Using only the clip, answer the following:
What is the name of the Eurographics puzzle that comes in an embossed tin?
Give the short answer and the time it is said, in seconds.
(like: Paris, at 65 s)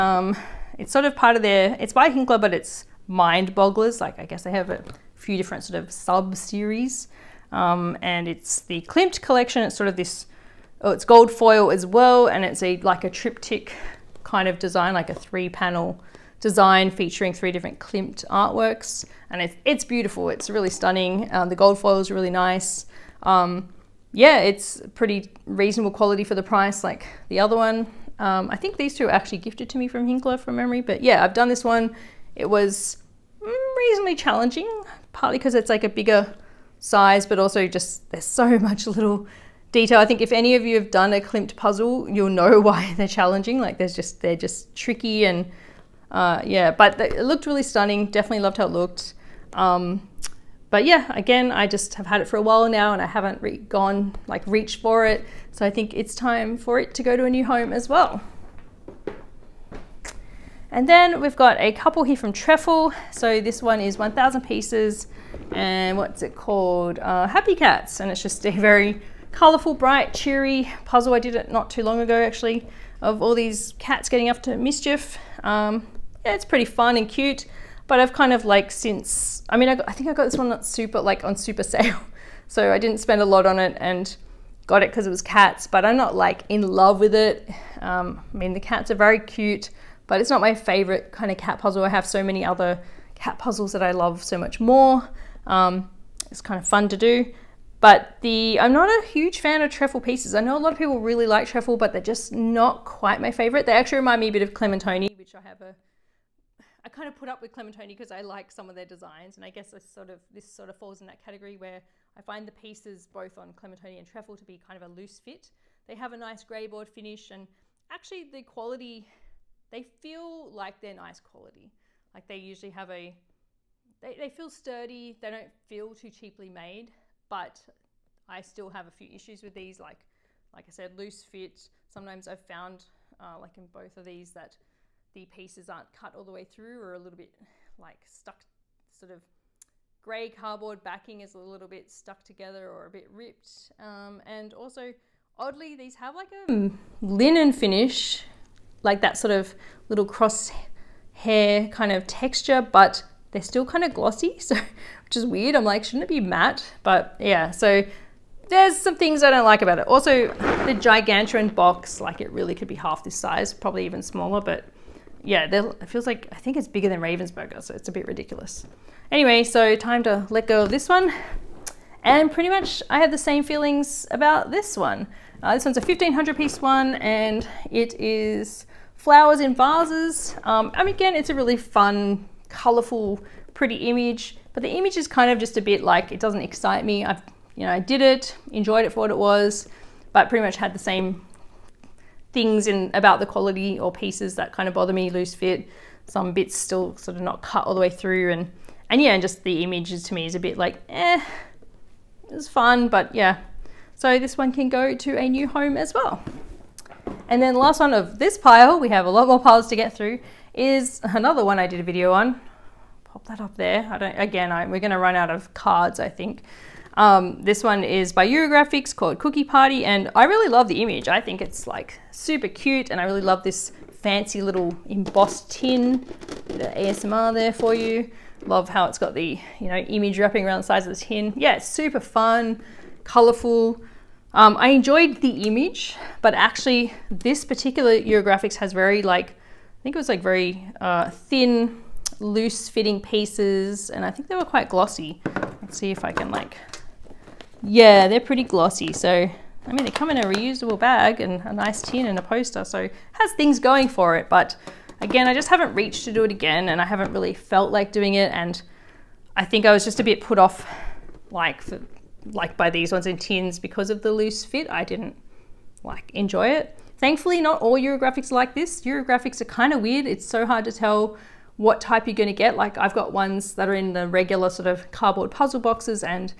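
Cookie Party, at 219 s.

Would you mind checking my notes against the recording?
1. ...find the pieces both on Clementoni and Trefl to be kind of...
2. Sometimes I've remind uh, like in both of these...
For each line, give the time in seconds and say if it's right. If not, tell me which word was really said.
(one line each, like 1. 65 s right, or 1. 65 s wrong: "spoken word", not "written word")
1. 112 s right
2. 131 s wrong: "found", not "remind".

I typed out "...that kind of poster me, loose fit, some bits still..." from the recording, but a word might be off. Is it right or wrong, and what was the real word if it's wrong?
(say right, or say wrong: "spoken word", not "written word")
wrong: "bother", not "poster".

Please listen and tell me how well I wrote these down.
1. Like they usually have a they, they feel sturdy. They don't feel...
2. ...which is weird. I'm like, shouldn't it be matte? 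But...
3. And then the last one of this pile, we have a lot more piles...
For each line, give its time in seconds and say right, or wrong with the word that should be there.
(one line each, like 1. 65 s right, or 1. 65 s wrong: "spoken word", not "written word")
1. 122 s right
2. 155 s right
3. 207 s right.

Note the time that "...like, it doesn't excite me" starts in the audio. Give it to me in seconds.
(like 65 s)
185 s.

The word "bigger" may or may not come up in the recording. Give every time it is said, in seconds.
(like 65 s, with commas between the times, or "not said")
35 s, 166 s.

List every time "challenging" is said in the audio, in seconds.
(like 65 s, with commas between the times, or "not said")
34 s, 43 s.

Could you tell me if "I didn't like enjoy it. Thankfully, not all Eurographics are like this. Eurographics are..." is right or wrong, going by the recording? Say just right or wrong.
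right.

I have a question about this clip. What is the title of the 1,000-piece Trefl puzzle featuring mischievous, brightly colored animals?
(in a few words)
Happy Cats.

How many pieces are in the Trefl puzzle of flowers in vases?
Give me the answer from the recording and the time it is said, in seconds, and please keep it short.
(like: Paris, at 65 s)
1500, at 175 s.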